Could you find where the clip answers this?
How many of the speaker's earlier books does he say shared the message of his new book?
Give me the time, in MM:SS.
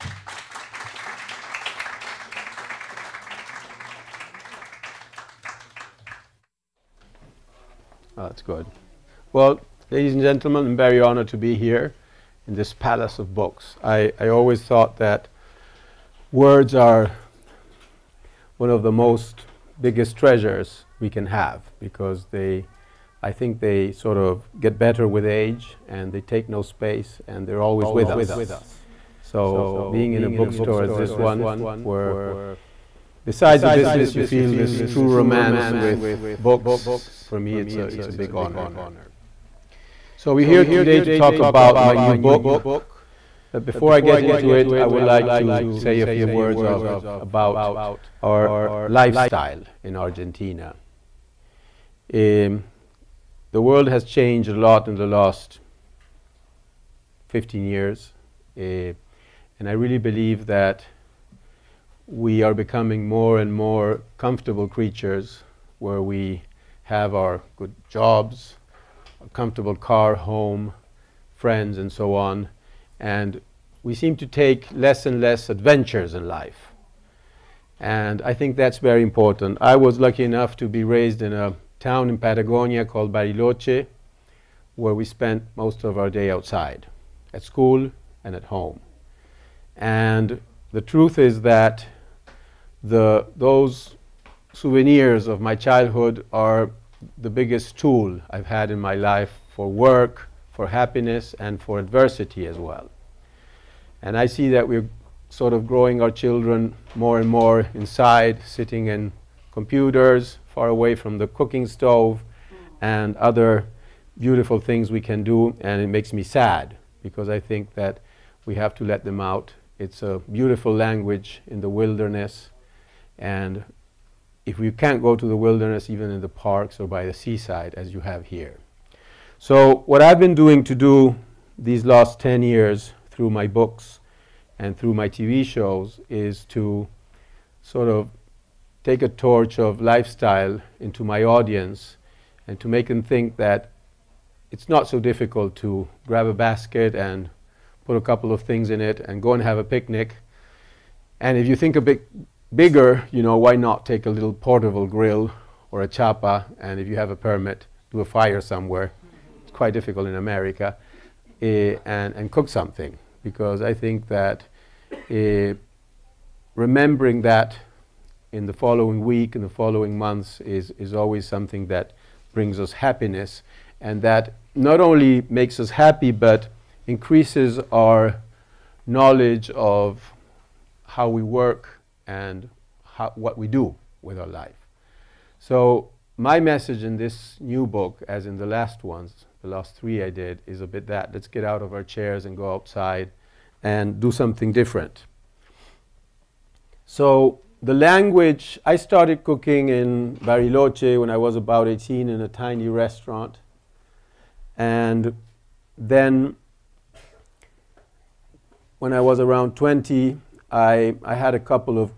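03:09.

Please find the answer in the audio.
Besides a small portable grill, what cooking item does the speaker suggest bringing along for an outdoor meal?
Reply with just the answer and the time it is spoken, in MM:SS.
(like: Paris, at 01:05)
a chapa, at 02:35.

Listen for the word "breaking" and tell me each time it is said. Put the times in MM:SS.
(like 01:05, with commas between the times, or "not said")
not said.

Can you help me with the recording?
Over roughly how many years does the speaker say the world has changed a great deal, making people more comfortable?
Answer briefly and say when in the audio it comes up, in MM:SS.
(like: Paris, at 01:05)
15, at 00:57.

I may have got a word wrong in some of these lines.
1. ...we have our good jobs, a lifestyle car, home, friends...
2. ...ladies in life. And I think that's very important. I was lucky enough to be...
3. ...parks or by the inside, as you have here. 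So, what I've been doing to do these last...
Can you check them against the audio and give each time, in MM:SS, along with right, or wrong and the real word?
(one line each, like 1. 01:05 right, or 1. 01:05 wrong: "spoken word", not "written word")
1. 01:06 wrong: "comfortable", not "lifestyle"
2. 01:15 wrong: "adventures", not "ladies"
3. 02:06 wrong: "seaside", not "inside".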